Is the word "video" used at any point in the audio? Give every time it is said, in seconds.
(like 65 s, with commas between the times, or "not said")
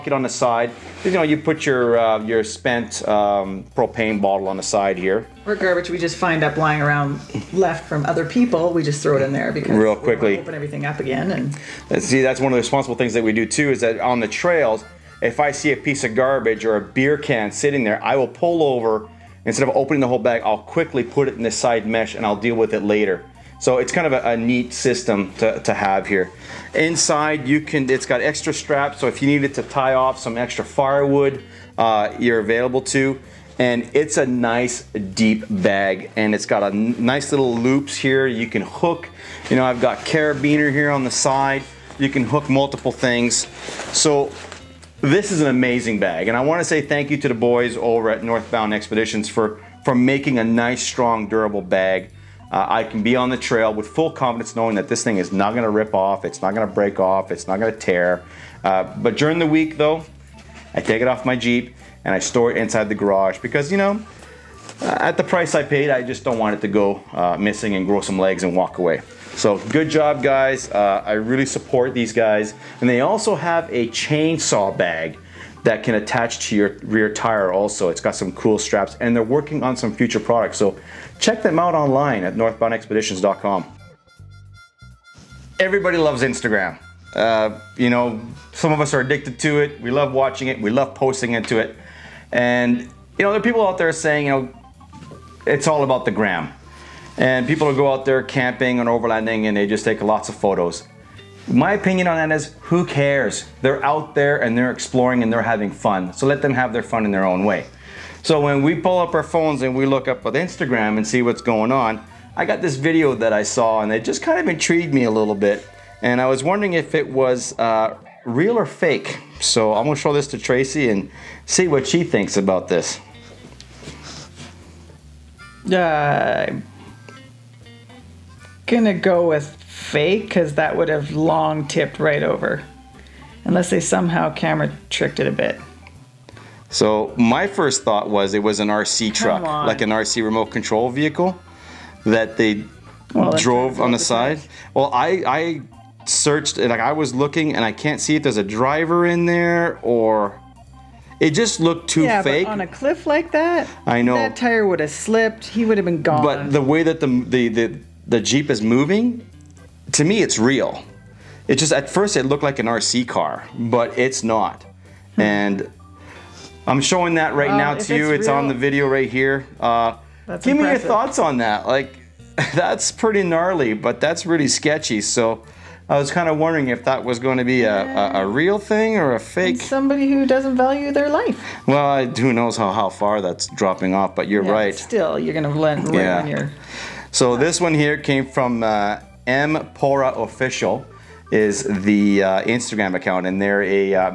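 112 s, 168 s.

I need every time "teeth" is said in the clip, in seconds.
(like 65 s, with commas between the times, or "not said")
not said.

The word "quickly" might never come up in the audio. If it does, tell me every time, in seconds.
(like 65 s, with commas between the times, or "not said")
9 s, 20 s.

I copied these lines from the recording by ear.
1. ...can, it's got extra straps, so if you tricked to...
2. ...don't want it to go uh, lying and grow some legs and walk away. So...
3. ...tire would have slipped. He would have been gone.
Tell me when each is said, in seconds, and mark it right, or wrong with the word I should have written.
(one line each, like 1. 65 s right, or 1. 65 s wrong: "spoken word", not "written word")
1. 27 s wrong: "needed", not "tricked"
2. 66 s wrong: "missing", not "lying"
3. 154 s right.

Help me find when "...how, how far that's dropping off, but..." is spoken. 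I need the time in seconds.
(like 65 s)
182 s.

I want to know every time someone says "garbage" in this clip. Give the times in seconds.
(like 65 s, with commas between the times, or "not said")
5 s, 16 s.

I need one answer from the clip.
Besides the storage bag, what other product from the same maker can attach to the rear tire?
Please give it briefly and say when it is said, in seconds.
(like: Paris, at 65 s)
Chainsaw bag, at 73 s.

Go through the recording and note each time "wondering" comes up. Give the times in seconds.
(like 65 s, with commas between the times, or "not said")
116 s, 176 s.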